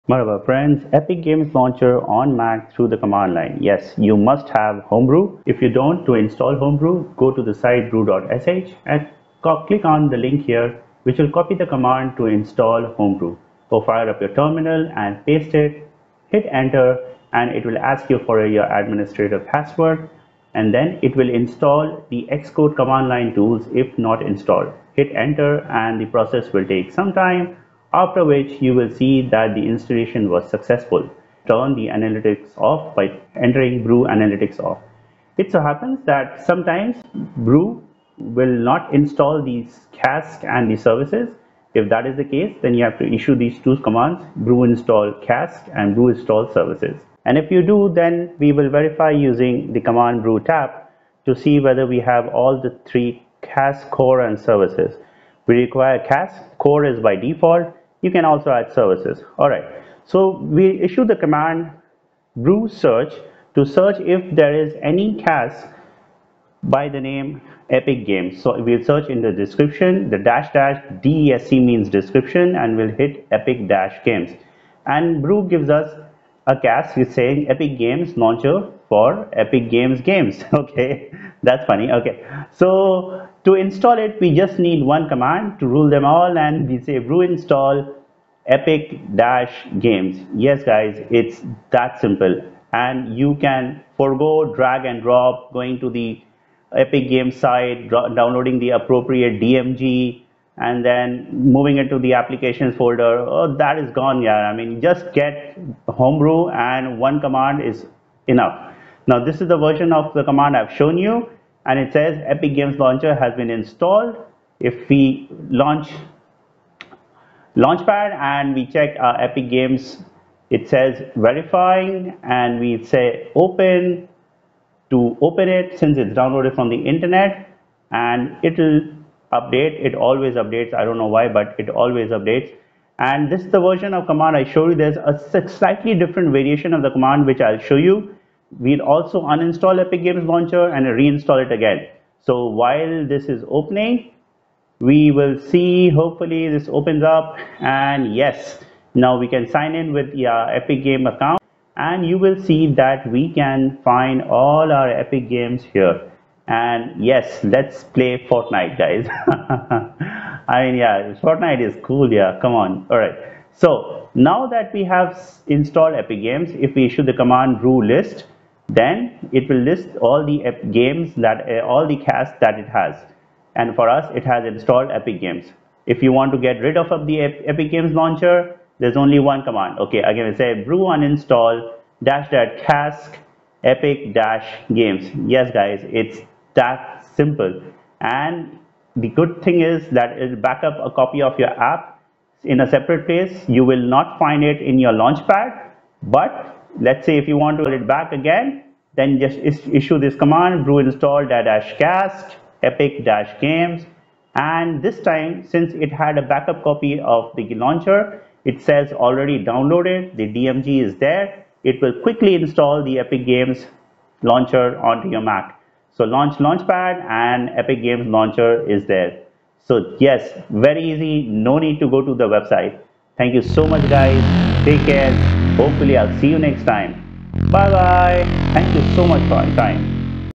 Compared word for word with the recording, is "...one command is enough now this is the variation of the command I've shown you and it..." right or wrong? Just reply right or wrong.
wrong.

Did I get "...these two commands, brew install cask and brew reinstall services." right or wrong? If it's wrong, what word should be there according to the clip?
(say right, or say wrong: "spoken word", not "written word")
wrong: "install", not "reinstall".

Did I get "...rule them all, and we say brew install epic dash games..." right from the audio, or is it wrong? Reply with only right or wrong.
right.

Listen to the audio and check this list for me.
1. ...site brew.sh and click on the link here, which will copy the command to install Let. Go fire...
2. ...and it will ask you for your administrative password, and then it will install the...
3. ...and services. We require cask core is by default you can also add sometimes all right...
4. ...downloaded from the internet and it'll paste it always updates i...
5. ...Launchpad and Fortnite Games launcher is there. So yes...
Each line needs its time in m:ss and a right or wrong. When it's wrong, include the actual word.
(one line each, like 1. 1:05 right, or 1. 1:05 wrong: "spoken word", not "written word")
1. 0:07 wrong: "Homebrew", not "Let"
2. 0:17 right
3. 0:54 wrong: "services", not "sometimes"
4. 2:06 wrong: "update", not "paste"
5. 3:36 wrong: "Epic", not "Fortnite".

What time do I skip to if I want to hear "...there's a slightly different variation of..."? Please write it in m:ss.
2:14.